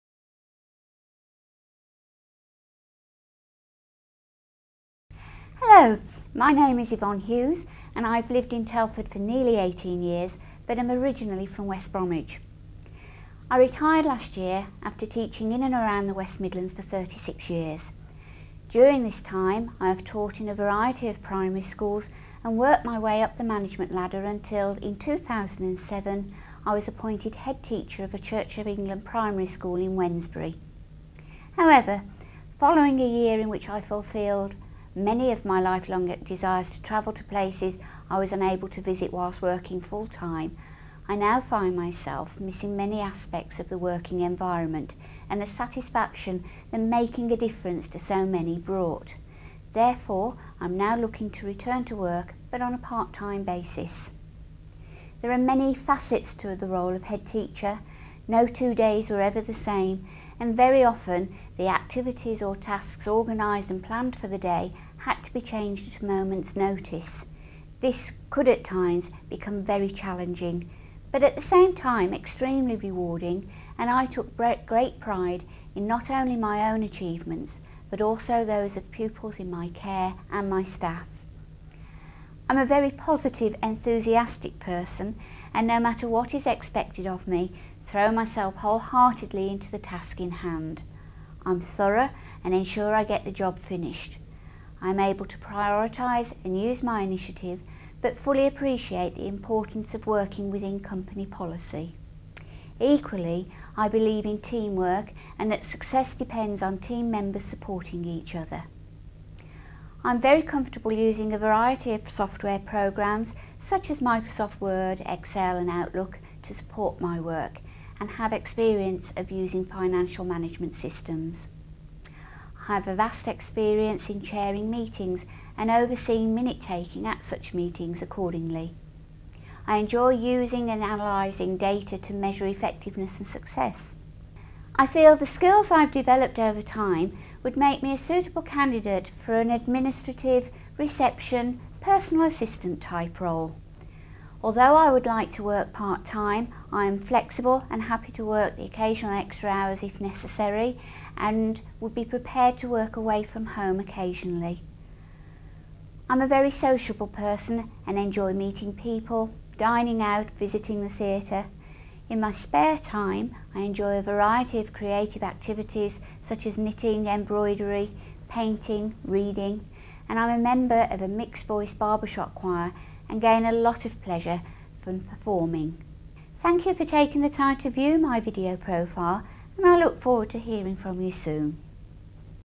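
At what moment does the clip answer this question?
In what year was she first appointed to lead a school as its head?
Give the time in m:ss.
0:24.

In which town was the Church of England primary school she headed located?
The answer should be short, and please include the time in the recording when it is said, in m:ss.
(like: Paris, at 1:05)
Wednesbury, at 0:29.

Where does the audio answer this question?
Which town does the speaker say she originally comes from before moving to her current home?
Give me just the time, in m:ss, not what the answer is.
0:11.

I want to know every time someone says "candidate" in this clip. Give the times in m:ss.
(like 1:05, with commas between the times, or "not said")
2:18.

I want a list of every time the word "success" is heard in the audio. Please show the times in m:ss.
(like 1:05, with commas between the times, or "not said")
1:45, 2:13.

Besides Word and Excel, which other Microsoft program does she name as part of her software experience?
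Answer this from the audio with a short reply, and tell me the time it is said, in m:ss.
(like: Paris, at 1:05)
Outlook, at 1:55.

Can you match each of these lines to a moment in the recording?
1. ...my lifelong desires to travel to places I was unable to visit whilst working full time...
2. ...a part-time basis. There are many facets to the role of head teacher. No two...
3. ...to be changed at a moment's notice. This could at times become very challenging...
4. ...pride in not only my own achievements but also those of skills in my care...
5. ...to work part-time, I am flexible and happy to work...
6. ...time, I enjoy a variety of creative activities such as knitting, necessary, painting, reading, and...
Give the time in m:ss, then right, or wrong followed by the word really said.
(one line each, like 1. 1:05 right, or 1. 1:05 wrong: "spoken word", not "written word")
1. 0:35 right
2. 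0:52 right
3. 1:05 right
4. 1:14 wrong: "pupils", not "skills"
5. 2:25 right
6. 2:42 wrong: "embroidery", not "necessary".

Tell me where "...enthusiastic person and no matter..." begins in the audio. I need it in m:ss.
1:23.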